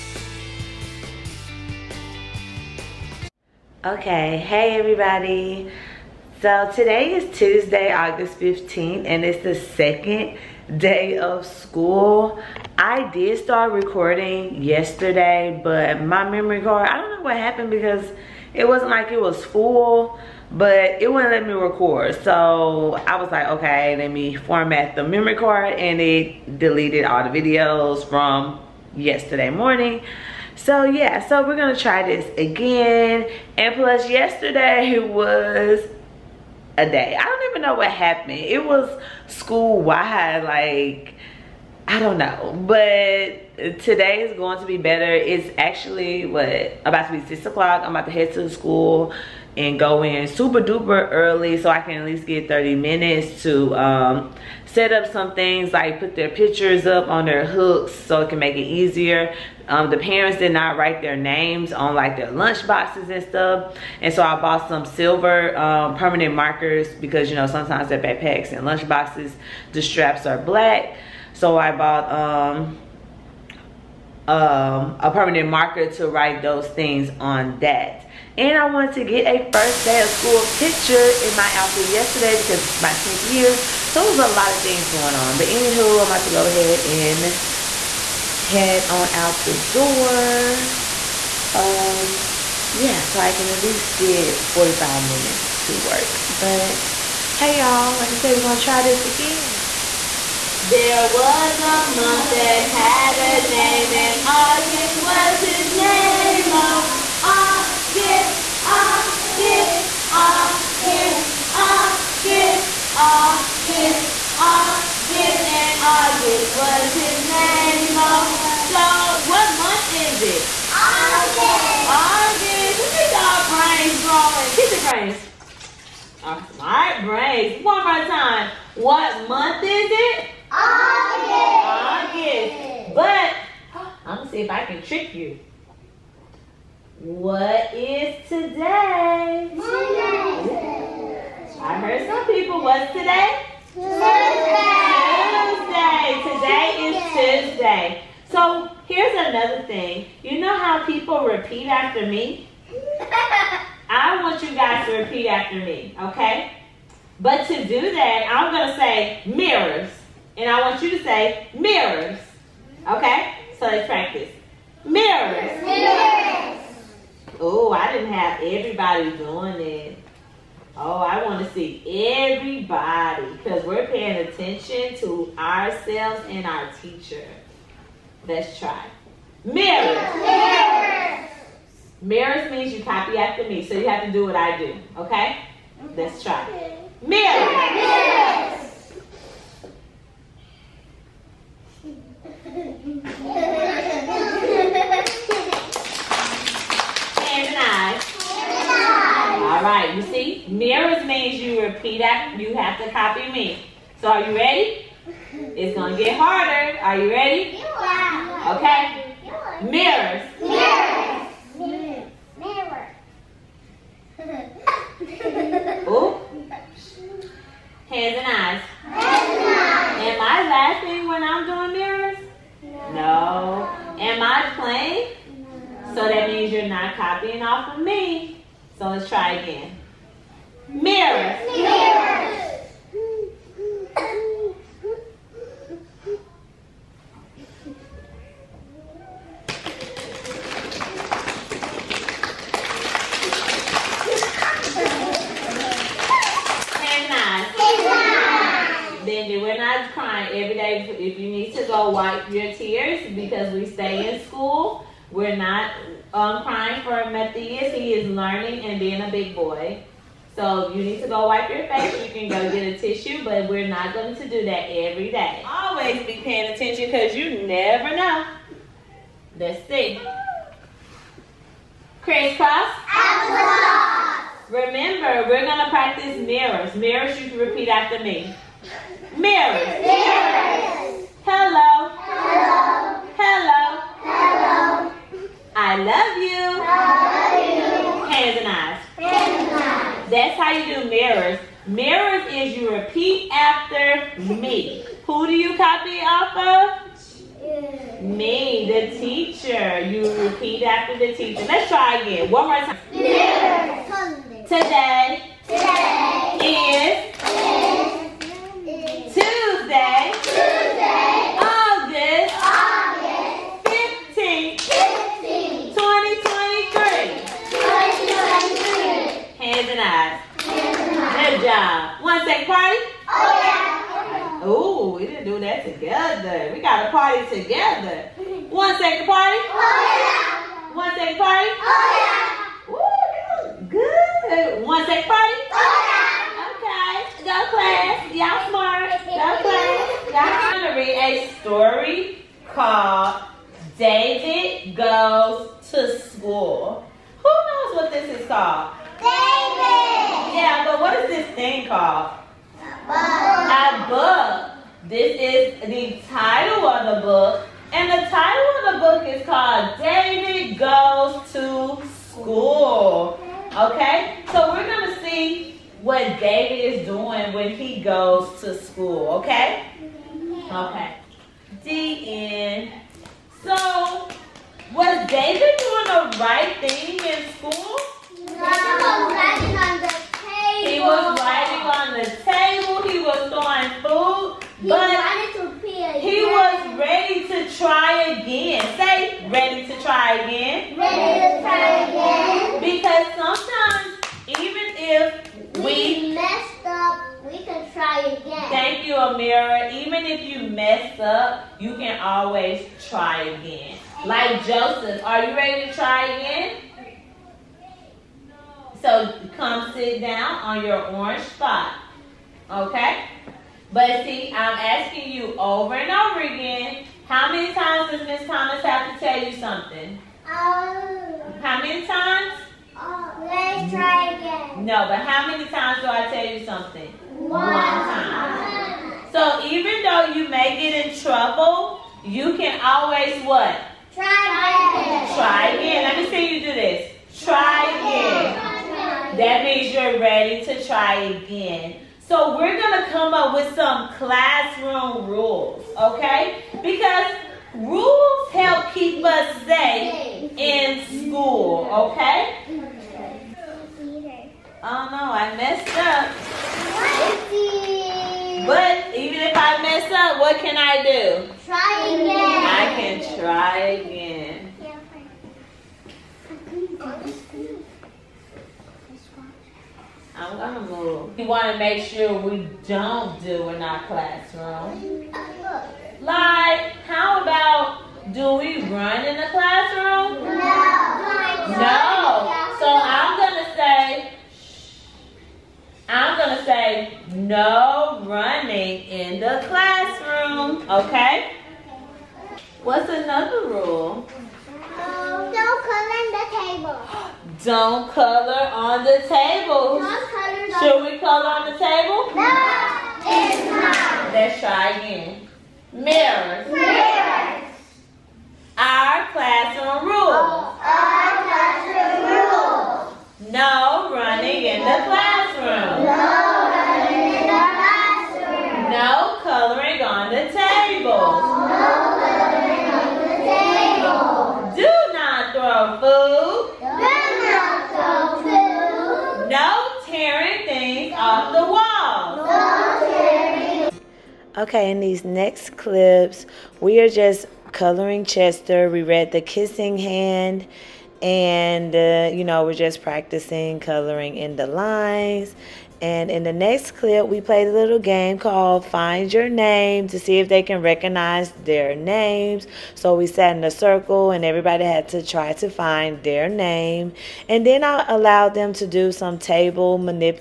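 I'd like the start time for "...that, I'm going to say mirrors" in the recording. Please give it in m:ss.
2:37.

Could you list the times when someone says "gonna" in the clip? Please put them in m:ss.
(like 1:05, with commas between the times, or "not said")
0:31, 1:38.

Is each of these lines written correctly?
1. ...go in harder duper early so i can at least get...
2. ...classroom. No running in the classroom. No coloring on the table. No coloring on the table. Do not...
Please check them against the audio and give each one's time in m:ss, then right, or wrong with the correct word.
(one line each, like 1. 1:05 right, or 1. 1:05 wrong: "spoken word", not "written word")
1. 0:49 wrong: "super", not "harder"
2. 8:34 right.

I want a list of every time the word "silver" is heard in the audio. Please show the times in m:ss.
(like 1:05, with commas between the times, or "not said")
1:04.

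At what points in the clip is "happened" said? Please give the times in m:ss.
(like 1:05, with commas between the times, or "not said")
0:17, 0:37.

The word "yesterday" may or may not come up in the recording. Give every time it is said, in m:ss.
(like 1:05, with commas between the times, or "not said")
0:14, 0:28, 0:34, 1:21.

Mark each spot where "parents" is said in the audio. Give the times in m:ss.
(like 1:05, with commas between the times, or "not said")
0:59.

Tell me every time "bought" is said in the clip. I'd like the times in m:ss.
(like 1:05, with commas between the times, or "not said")
1:04, 1:11.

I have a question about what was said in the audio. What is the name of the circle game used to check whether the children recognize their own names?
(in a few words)
Find Your Name.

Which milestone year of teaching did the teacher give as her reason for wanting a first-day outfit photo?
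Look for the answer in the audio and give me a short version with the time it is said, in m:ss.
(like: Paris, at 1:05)
10th year, at 1:22.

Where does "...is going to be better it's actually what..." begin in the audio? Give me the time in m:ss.
0:44.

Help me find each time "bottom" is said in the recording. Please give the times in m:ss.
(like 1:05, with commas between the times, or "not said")
not said.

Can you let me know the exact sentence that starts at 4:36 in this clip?
Mirrors, you can repeat after me.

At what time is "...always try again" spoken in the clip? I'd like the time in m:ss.
6:42.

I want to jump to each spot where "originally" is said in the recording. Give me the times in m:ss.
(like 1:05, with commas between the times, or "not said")
not said.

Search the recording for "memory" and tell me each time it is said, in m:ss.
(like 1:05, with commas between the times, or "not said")
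0:16, 0:25.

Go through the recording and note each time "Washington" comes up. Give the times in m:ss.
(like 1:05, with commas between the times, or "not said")
not said.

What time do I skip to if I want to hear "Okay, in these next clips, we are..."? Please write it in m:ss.
8:54.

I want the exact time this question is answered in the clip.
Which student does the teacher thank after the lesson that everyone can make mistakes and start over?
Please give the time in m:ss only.
6:38.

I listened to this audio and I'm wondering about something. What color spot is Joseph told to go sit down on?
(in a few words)
Orange.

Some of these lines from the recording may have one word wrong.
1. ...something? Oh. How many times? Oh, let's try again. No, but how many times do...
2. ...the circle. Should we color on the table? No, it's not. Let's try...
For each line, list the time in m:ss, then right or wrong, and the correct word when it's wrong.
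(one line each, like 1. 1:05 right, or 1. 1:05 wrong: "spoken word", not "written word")
1. 6:59 right
2. 8:18 wrong: "table", not "circle".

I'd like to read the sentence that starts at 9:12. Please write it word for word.
So we sat in a circle and everybody had to try to find their name.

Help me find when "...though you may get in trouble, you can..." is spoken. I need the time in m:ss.
7:09.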